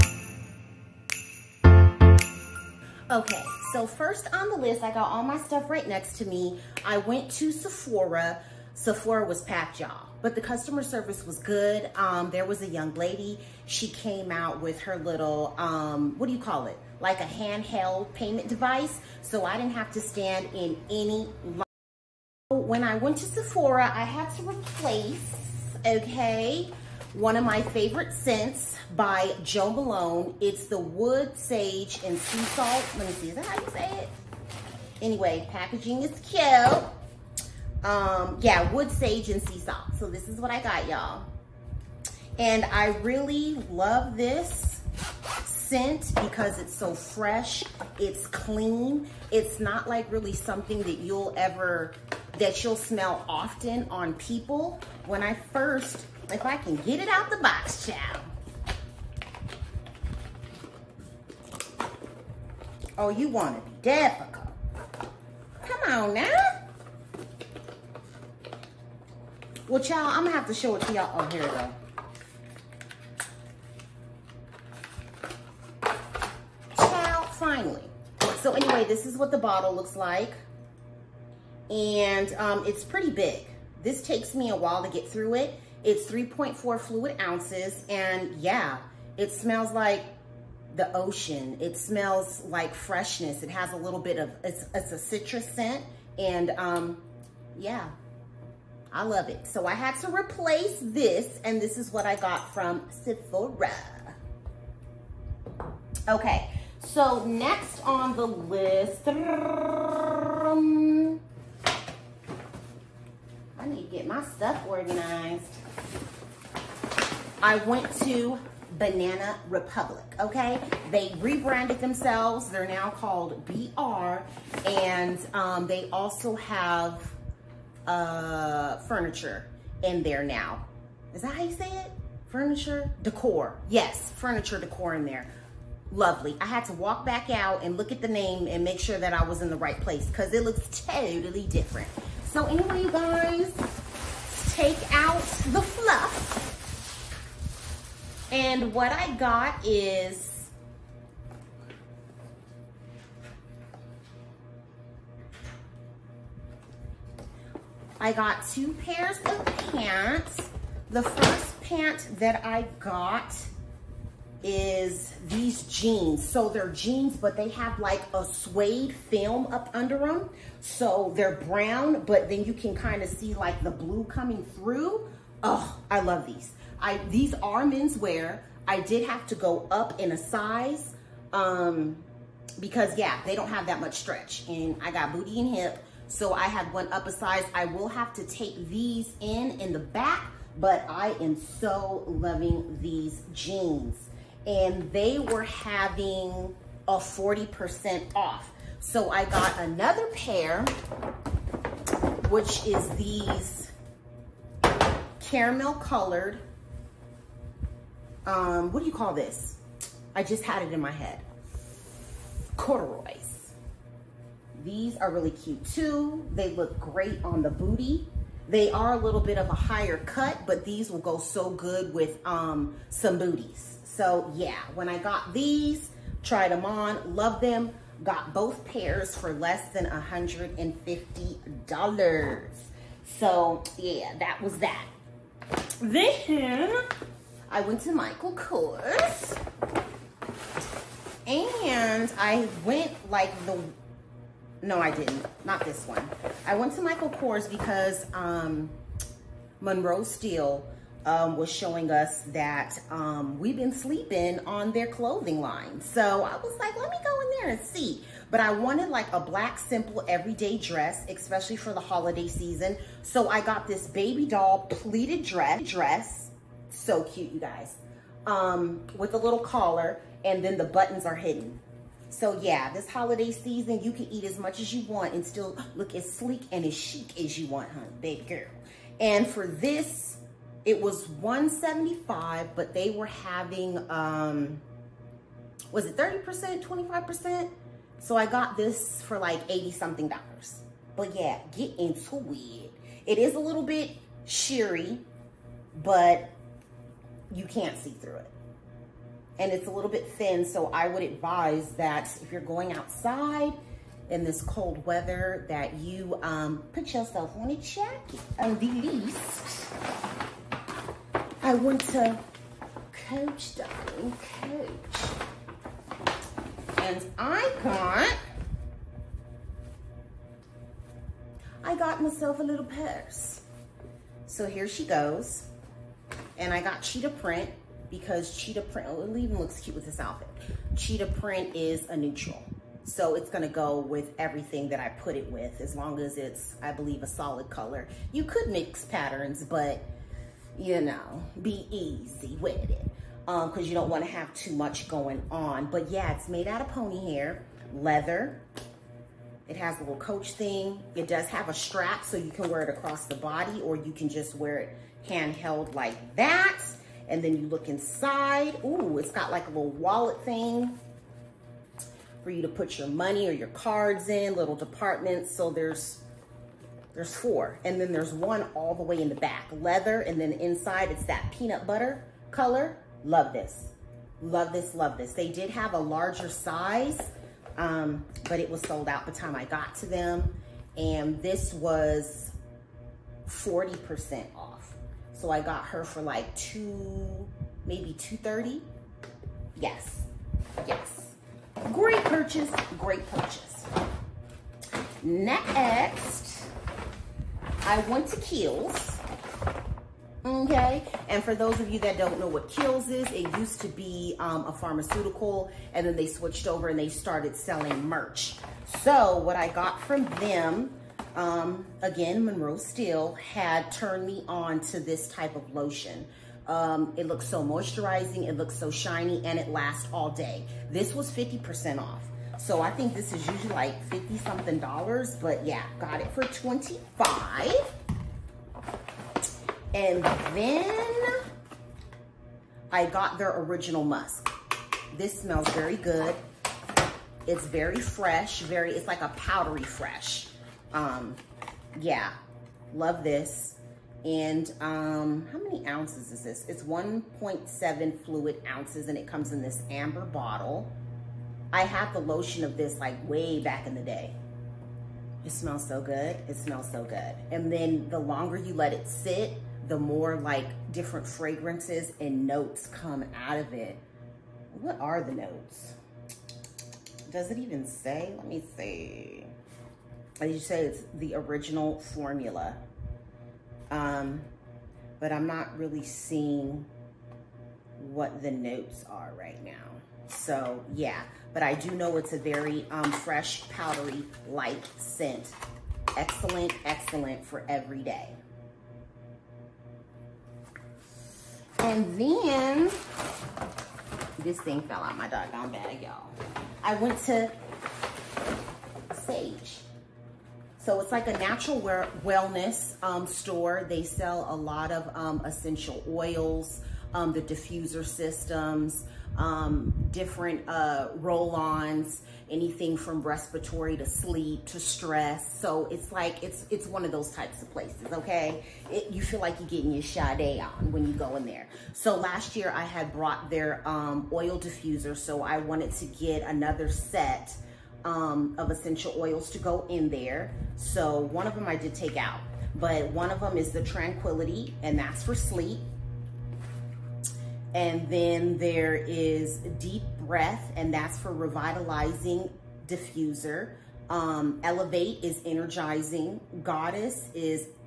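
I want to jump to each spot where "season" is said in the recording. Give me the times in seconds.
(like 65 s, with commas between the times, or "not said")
262 s, 273 s.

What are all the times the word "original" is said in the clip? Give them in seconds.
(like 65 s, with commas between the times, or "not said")
433 s, 471 s.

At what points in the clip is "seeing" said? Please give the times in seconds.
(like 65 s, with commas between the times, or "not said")
475 s.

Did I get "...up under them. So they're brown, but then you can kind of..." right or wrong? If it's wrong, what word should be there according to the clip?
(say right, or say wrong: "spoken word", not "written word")
right.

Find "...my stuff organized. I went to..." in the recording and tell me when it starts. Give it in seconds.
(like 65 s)
114 s.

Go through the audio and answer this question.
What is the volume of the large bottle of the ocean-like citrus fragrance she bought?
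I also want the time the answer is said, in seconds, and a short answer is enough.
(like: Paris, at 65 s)
3.4 fluid ounces, at 86 s.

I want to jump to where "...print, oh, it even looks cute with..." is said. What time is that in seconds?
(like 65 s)
328 s.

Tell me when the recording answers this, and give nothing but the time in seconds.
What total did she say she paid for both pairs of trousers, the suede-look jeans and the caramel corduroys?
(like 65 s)
229 s.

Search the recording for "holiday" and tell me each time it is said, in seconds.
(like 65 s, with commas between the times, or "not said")
261 s, 272 s.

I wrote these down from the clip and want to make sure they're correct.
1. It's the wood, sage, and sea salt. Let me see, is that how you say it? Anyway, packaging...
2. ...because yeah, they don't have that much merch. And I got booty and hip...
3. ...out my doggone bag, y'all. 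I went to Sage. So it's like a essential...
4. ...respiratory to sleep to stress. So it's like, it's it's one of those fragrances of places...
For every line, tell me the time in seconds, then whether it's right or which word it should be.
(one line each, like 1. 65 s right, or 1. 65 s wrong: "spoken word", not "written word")
1. 30 s right
2. 182 s wrong: "stretch", not "merch"
3. 494 s wrong: "natural", not "essential"
4. 513 s wrong: "types", not "fragrances".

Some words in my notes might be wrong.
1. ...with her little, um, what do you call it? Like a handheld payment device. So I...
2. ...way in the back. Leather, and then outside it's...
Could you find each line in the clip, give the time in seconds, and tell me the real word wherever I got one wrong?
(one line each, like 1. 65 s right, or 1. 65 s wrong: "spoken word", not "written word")
1. 14 s right
2. 368 s wrong: "inside", not "outside".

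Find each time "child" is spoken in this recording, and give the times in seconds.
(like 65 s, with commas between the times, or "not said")
57 s, 76 s.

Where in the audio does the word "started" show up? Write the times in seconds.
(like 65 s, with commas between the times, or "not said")
406 s.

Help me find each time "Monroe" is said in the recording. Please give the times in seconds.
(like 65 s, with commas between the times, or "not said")
249 s, 412 s.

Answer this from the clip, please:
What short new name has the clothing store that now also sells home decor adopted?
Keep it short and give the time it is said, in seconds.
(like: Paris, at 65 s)
BR, at 123 s.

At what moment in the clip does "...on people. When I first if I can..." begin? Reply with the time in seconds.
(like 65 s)
53 s.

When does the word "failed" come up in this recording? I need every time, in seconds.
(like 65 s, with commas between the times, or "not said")
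not said.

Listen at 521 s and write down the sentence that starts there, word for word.
So last year I had brought their um, oil diffuser.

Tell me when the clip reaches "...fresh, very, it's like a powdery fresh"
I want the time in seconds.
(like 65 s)
437 s.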